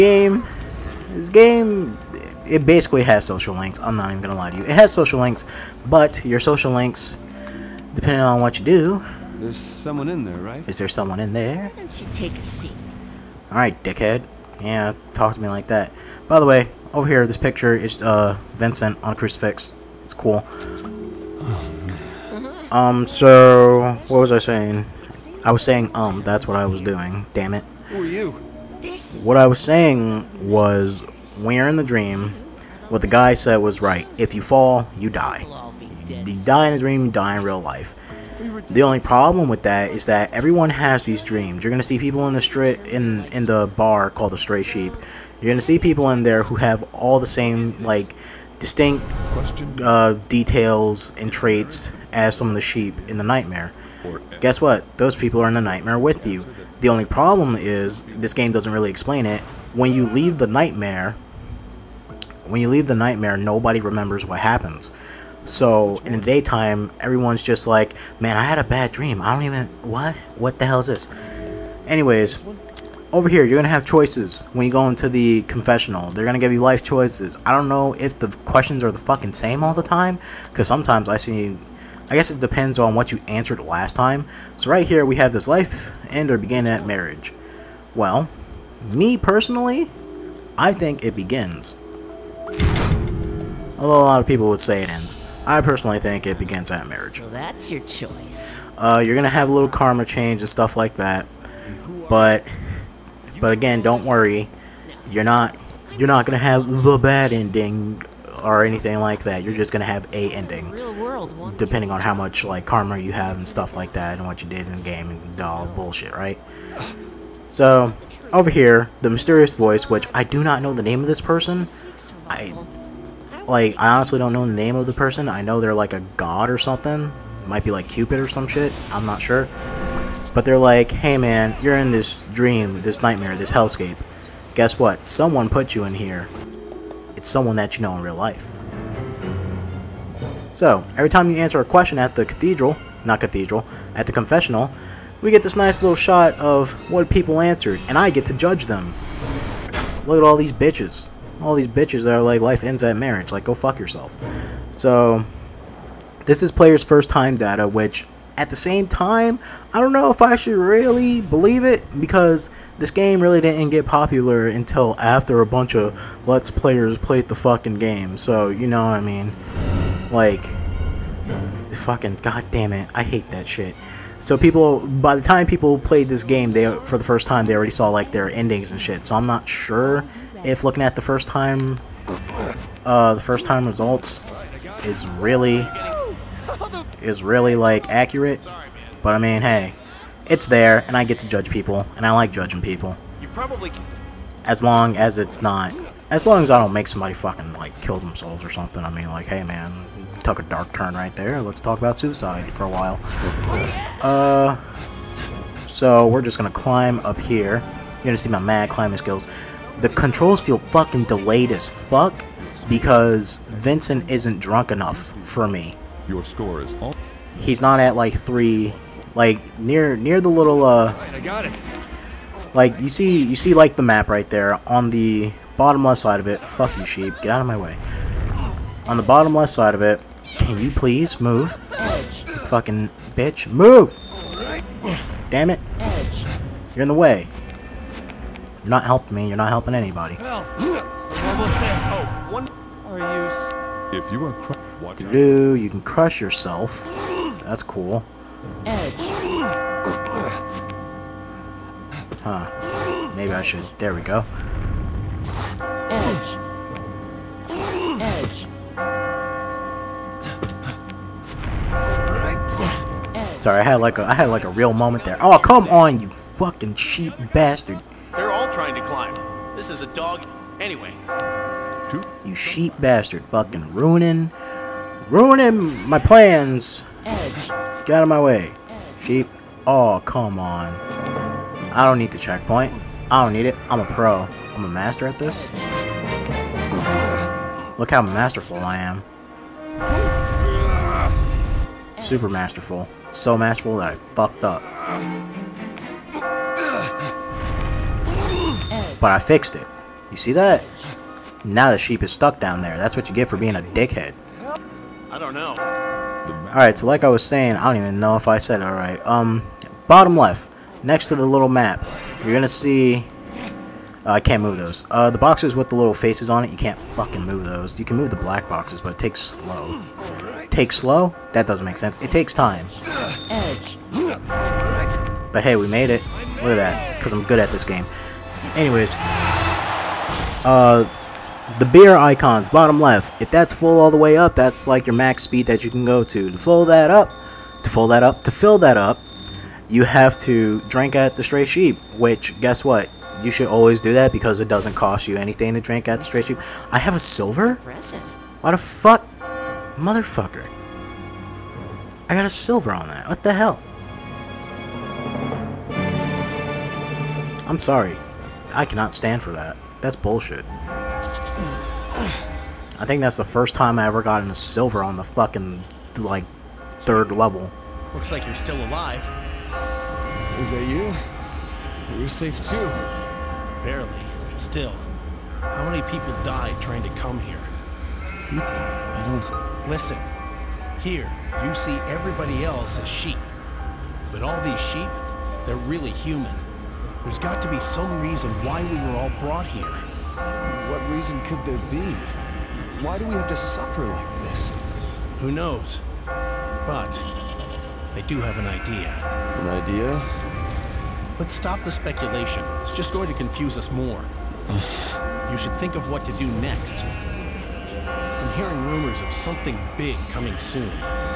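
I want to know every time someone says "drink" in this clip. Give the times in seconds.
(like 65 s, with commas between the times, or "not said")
340 s, 345 s.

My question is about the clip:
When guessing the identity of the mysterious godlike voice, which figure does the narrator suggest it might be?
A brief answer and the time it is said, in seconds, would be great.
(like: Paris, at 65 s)
Cupid, at 127 s.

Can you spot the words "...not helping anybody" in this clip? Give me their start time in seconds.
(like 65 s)
239 s.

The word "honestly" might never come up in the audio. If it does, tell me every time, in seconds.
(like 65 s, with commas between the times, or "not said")
123 s.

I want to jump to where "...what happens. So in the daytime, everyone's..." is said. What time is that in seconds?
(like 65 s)
64 s.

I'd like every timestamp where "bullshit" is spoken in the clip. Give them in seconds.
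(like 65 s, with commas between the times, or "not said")
115 s, 359 s.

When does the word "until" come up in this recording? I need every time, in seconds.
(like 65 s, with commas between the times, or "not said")
164 s.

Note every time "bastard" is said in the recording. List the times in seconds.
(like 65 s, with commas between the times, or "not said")
267 s, 272 s.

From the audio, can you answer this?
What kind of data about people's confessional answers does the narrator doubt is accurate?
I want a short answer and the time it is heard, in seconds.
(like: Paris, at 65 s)
Player's first time data, at 156 s.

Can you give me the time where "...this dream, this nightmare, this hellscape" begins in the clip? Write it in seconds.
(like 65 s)
131 s.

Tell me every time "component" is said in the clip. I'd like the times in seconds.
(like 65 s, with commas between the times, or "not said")
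not said.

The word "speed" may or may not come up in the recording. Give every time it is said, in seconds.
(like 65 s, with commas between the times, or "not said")
335 s.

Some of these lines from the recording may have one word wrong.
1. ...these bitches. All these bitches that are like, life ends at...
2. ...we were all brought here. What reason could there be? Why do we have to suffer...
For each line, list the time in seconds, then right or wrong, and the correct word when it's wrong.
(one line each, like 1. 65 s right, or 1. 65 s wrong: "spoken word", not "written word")
1. 150 s right
2. 388 s right.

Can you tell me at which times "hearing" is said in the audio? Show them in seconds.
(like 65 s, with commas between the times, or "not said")
408 s.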